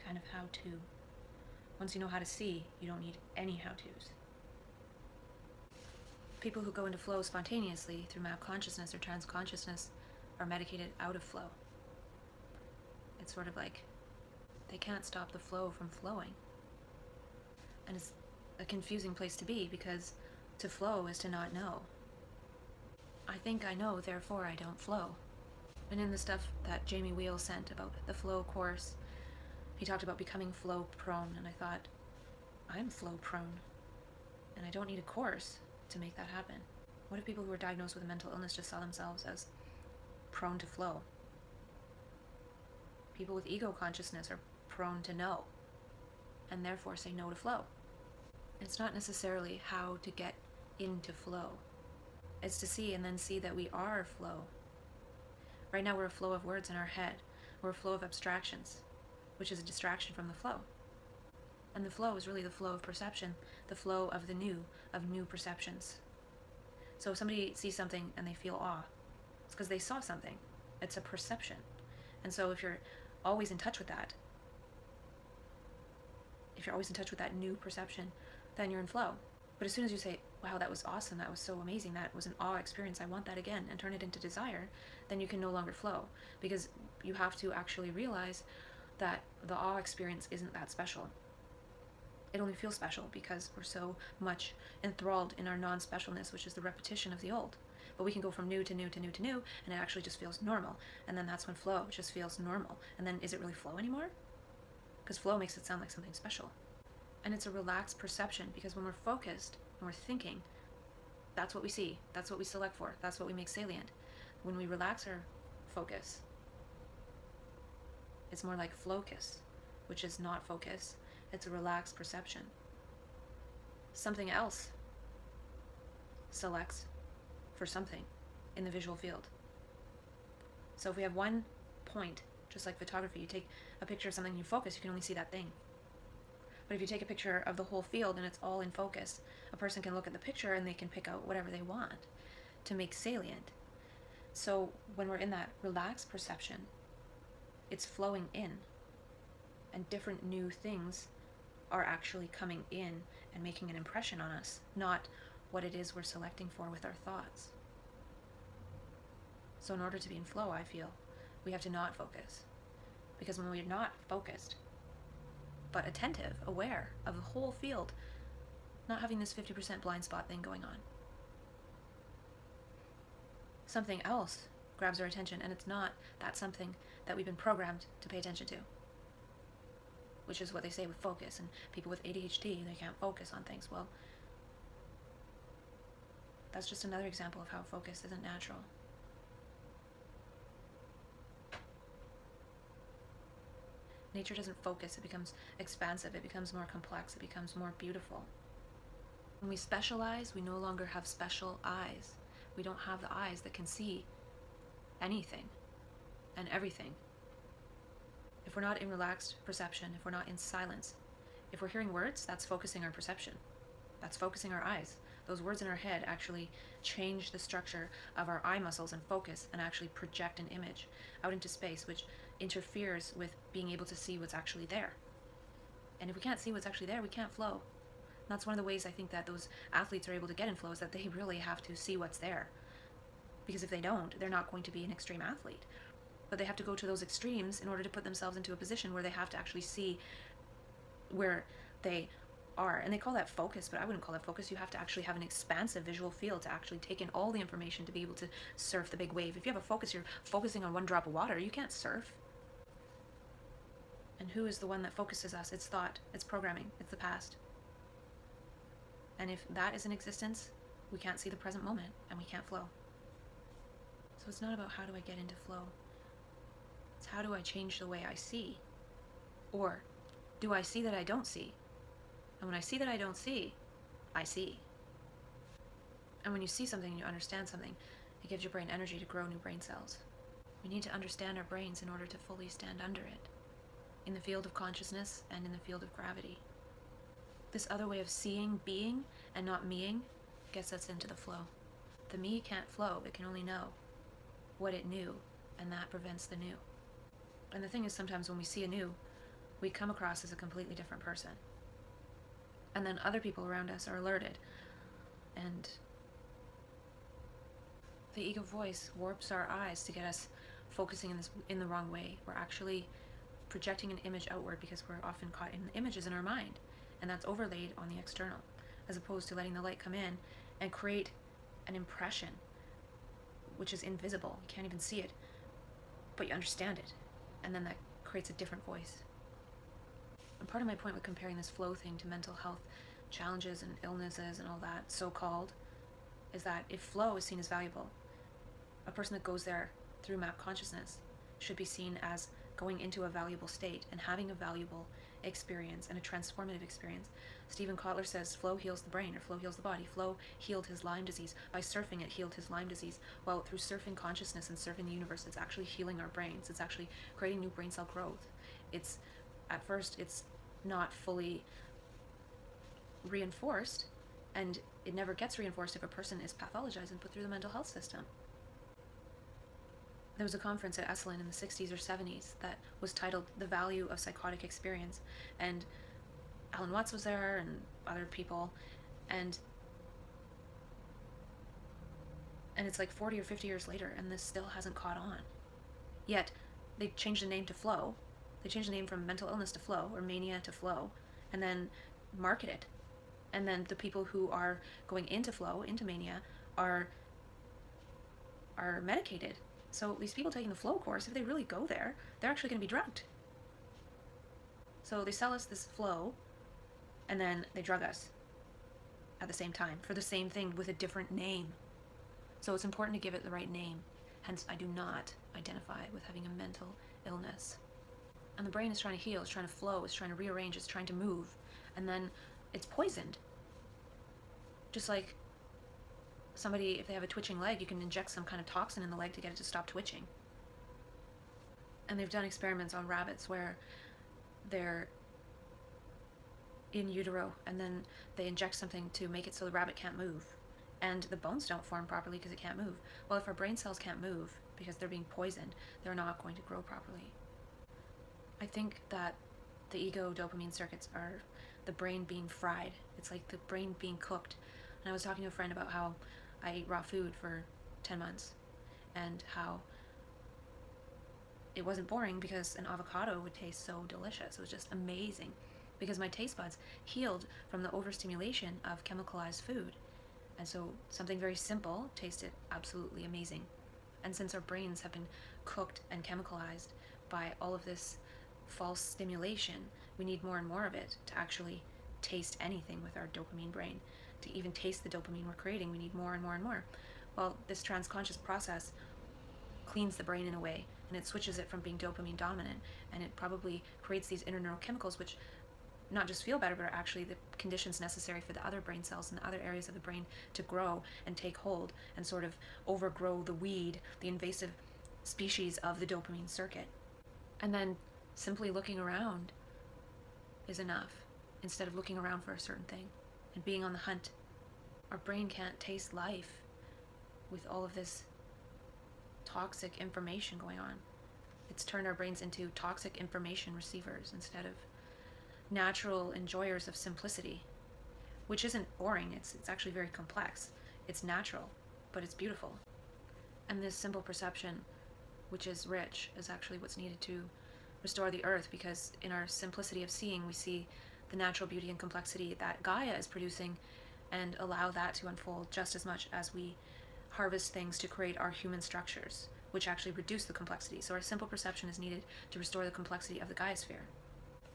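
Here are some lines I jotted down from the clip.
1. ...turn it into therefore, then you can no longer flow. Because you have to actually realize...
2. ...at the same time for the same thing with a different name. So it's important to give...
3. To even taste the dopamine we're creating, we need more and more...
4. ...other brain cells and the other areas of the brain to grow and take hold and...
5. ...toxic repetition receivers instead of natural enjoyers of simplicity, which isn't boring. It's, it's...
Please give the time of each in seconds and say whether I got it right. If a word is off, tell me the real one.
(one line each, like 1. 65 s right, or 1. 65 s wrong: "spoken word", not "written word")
1. 83 s wrong: "desire", not "therefore"
2. 409 s right
3. 484 s right
4. 498 s right
5. 522 s wrong: "information", not "repetition".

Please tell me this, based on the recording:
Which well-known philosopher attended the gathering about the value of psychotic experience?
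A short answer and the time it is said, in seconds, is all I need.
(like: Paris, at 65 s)
Alan Watts, at 376 s.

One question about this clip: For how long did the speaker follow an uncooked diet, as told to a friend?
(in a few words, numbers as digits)
10 months.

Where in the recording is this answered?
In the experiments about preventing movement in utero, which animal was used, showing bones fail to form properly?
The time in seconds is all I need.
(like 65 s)
432 s.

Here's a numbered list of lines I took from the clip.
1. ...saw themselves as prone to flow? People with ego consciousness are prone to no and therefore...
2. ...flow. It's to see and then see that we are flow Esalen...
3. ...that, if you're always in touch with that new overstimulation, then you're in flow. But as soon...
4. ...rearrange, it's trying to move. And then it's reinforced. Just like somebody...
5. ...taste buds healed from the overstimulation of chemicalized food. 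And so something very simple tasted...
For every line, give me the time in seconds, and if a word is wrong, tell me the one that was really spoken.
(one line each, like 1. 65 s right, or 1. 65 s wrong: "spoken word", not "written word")
1. 38 s right
2. 51 s wrong: "Right", not "Esalen"
3. 73 s wrong: "perception", not "overstimulation"
4. 420 s wrong: "poisoned", not "reinforced"
5. 466 s right.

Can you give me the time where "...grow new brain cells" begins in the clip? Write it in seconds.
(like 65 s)
279 s.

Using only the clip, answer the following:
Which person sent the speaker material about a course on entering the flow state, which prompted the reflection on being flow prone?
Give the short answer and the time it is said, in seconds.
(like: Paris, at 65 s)
Jamie Wheal, at 26 s.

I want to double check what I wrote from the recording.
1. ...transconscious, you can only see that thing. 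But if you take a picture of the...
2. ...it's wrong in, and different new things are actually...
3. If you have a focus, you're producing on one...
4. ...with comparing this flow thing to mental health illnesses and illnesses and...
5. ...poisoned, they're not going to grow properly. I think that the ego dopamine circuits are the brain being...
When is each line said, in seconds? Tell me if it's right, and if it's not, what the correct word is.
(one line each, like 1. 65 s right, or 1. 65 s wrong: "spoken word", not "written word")
1. 134 s wrong: "focus", not "transconscious"
2. 147 s wrong: "flowing", not "wrong"
3. 249 s wrong: "focusing", not "producing"
4. 330 s wrong: "challenges", not "illnesses"
5. 445 s right.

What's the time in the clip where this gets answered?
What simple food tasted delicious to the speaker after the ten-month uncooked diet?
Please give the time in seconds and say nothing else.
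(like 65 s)
462 s.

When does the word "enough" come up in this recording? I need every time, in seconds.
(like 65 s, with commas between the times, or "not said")
510 s.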